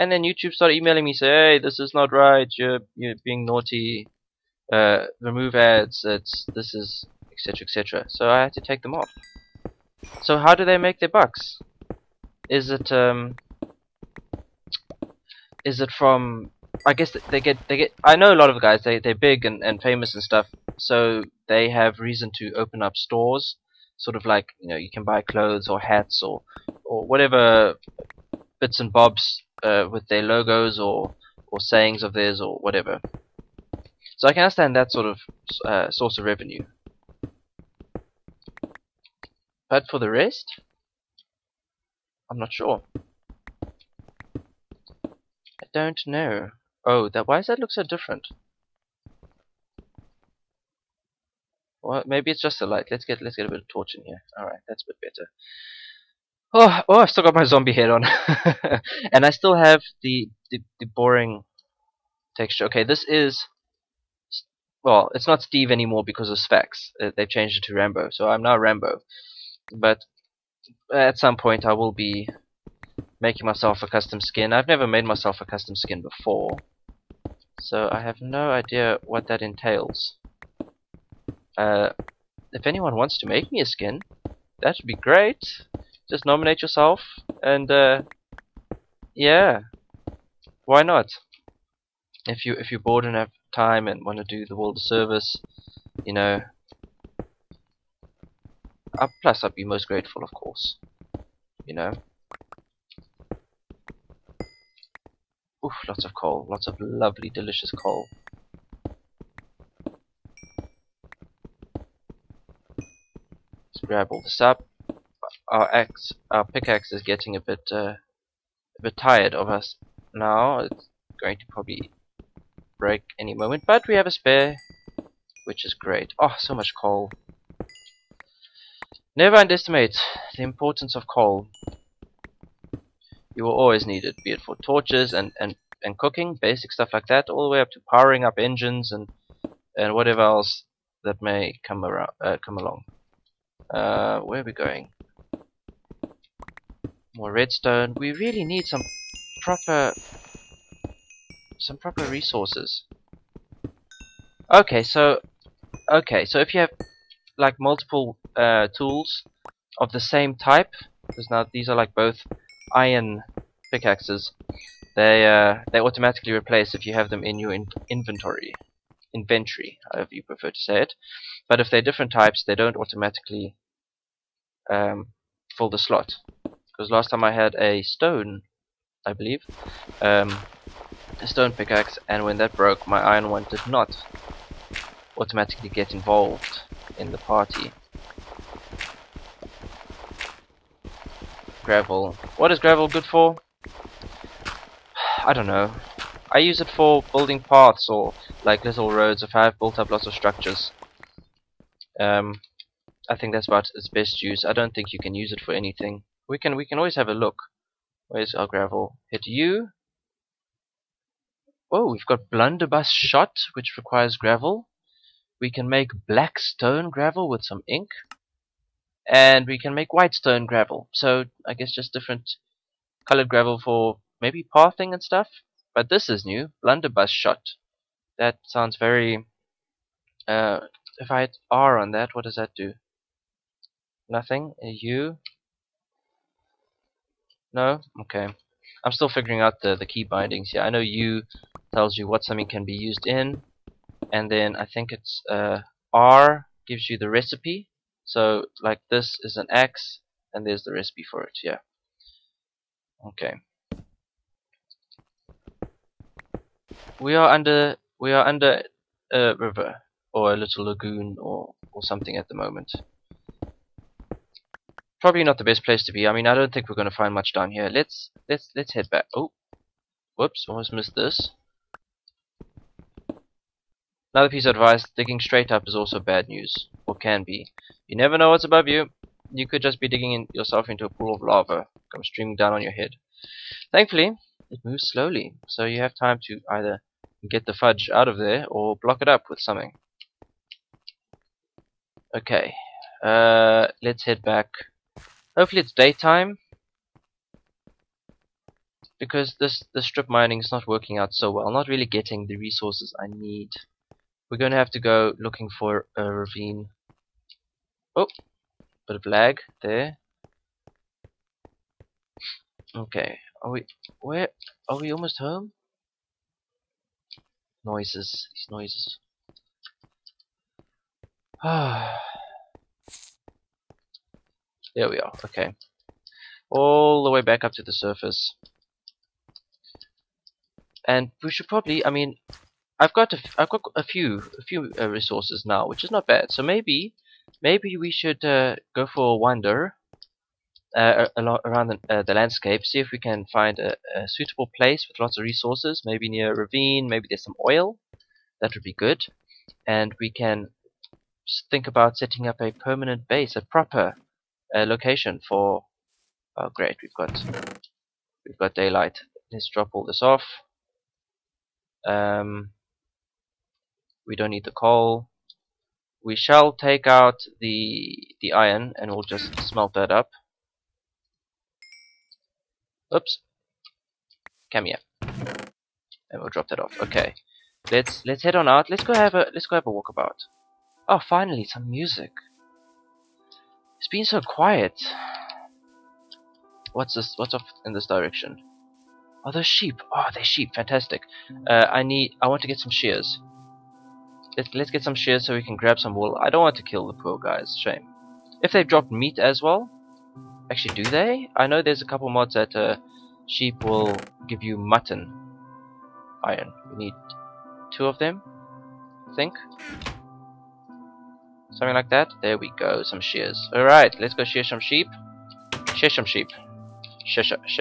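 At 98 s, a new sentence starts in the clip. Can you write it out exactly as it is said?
Uh, plus, I'd be most grateful, of course.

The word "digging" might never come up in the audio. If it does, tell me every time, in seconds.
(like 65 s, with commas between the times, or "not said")
274 s, 279 s.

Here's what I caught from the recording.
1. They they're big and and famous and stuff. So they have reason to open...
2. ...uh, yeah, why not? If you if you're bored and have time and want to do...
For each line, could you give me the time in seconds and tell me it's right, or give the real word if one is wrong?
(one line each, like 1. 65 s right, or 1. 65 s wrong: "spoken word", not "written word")
1. 18 s right
2. 87 s right.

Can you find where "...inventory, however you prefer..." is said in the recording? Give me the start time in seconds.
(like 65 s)
169 s.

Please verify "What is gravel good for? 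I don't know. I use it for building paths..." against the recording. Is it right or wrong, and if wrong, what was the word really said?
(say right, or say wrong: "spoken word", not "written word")
right.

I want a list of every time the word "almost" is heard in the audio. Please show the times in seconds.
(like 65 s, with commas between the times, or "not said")
270 s, 314 s.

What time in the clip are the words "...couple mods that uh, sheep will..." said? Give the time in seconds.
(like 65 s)
401 s.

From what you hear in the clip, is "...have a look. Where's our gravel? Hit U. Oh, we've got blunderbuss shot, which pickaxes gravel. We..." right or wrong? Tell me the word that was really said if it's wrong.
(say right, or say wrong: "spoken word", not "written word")
wrong: "requires", not "pickaxes".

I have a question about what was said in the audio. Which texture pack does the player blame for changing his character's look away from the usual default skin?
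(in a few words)
Sphax.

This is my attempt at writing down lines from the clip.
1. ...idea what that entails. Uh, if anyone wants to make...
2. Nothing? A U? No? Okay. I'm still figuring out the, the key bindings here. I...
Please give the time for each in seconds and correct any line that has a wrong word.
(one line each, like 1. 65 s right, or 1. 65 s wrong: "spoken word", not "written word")
1. 78 s right
2. 234 s right.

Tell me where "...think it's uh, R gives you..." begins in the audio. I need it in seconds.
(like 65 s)
244 s.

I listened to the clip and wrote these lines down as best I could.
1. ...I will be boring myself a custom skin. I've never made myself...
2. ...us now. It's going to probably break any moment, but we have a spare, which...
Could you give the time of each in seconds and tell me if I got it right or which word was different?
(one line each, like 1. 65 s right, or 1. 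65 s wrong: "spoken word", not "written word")
1. 71 s wrong: "making", not "boring"
2. 119 s right.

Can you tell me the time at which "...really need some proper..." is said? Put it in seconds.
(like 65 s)
148 s.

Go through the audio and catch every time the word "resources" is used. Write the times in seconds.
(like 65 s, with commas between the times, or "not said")
152 s, 302 s, 334 s, 345 s.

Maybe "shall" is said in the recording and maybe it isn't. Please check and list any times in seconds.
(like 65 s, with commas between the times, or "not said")
366 s.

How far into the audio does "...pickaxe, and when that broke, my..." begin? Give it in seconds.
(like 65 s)
181 s.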